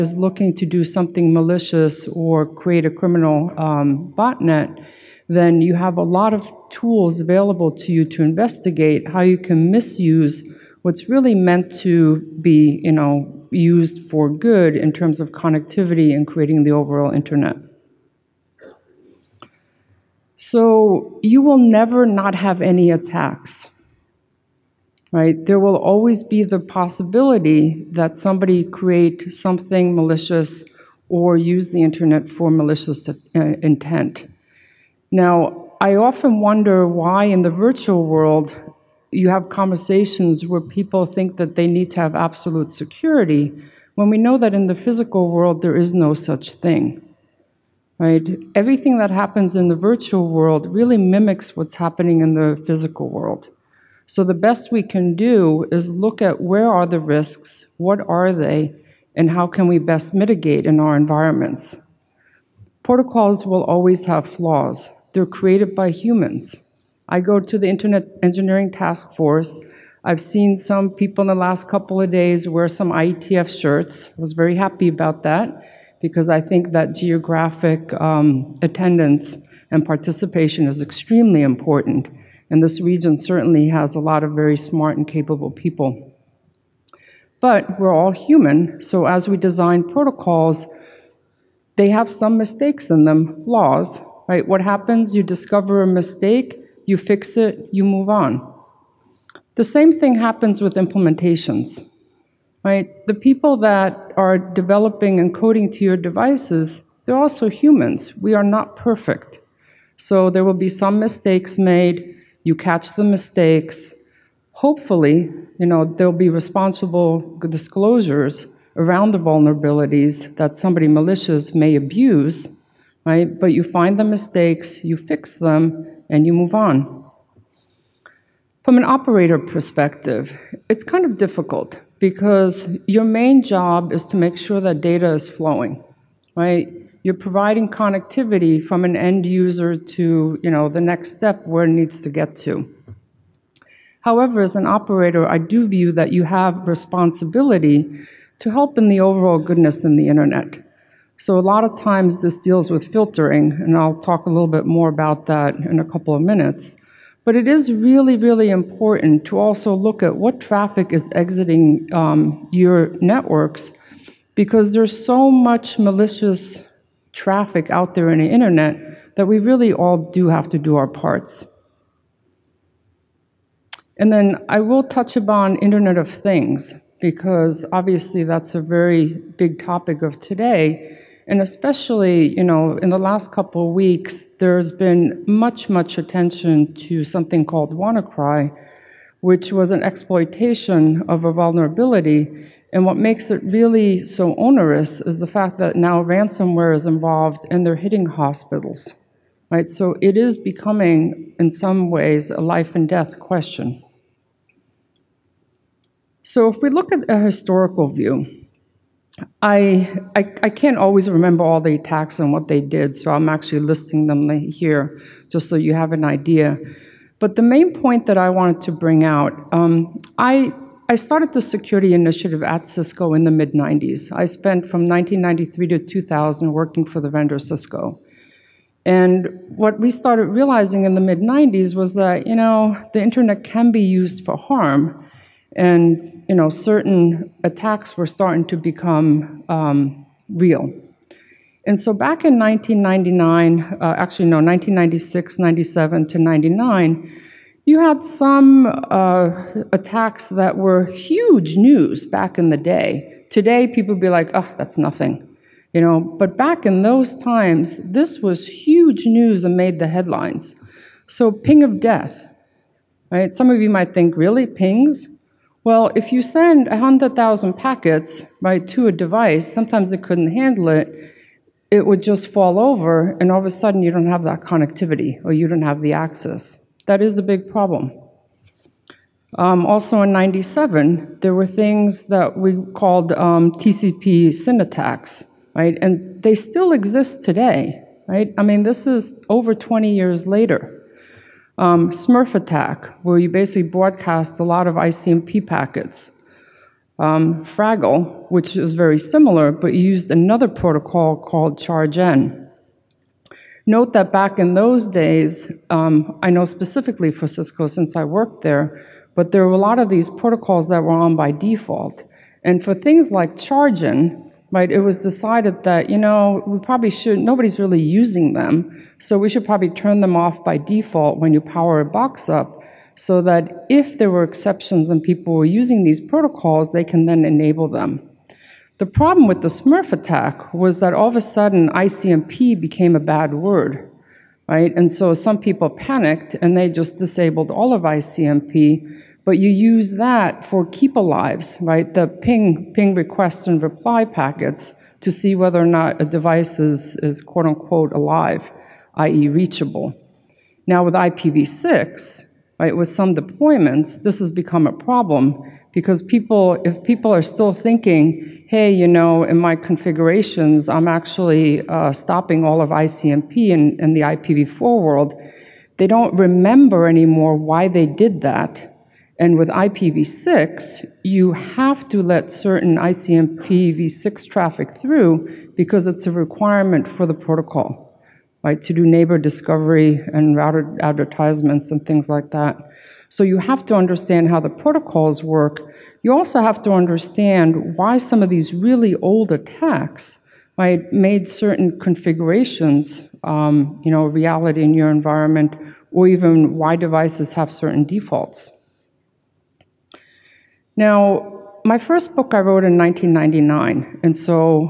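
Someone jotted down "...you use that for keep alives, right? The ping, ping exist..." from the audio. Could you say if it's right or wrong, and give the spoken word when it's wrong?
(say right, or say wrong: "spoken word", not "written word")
wrong: "request", not "exist".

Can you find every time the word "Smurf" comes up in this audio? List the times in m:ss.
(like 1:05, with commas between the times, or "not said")
4:51, 5:29.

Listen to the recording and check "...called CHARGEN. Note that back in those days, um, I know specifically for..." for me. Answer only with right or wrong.
right.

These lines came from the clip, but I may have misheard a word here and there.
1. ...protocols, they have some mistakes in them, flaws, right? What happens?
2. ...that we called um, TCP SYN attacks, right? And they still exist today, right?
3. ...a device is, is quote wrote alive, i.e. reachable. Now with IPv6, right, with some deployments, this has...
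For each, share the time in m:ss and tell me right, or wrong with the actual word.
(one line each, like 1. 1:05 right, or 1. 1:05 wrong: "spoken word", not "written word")
1. 1:29 right
2. 4:42 right
3. 5:46 wrong: "unquote", not "wrote".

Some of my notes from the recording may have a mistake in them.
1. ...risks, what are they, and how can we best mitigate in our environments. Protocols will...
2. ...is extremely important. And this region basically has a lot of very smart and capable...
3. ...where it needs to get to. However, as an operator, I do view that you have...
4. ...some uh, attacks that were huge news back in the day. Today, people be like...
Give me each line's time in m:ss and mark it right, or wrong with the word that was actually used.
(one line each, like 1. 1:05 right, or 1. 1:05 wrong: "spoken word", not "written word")
1. 0:56 right
2. 1:20 wrong: "certainly", not "basically"
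3. 2:21 right
4. 4:08 right.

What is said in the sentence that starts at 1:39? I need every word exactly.
The same thing happens with implementations, right?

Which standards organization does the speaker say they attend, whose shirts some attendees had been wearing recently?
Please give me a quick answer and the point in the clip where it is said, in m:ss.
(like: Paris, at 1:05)
Internet Engineering Task Force, at 1:07.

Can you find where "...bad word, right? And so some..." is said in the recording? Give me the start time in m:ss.
5:32.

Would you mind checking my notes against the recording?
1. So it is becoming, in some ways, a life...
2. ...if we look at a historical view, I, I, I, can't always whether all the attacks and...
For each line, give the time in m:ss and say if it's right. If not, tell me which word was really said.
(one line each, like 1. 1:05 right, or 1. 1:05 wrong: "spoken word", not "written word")
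1. 3:19 right
2. 3:26 wrong: "remember", not "whether".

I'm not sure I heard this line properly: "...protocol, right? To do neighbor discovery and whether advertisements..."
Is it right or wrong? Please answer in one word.
wrong.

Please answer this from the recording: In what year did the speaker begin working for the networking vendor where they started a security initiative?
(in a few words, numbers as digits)
1993.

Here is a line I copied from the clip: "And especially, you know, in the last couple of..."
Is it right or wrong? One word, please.
right.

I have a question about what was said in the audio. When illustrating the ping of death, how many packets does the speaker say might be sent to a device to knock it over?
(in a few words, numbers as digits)
100,000.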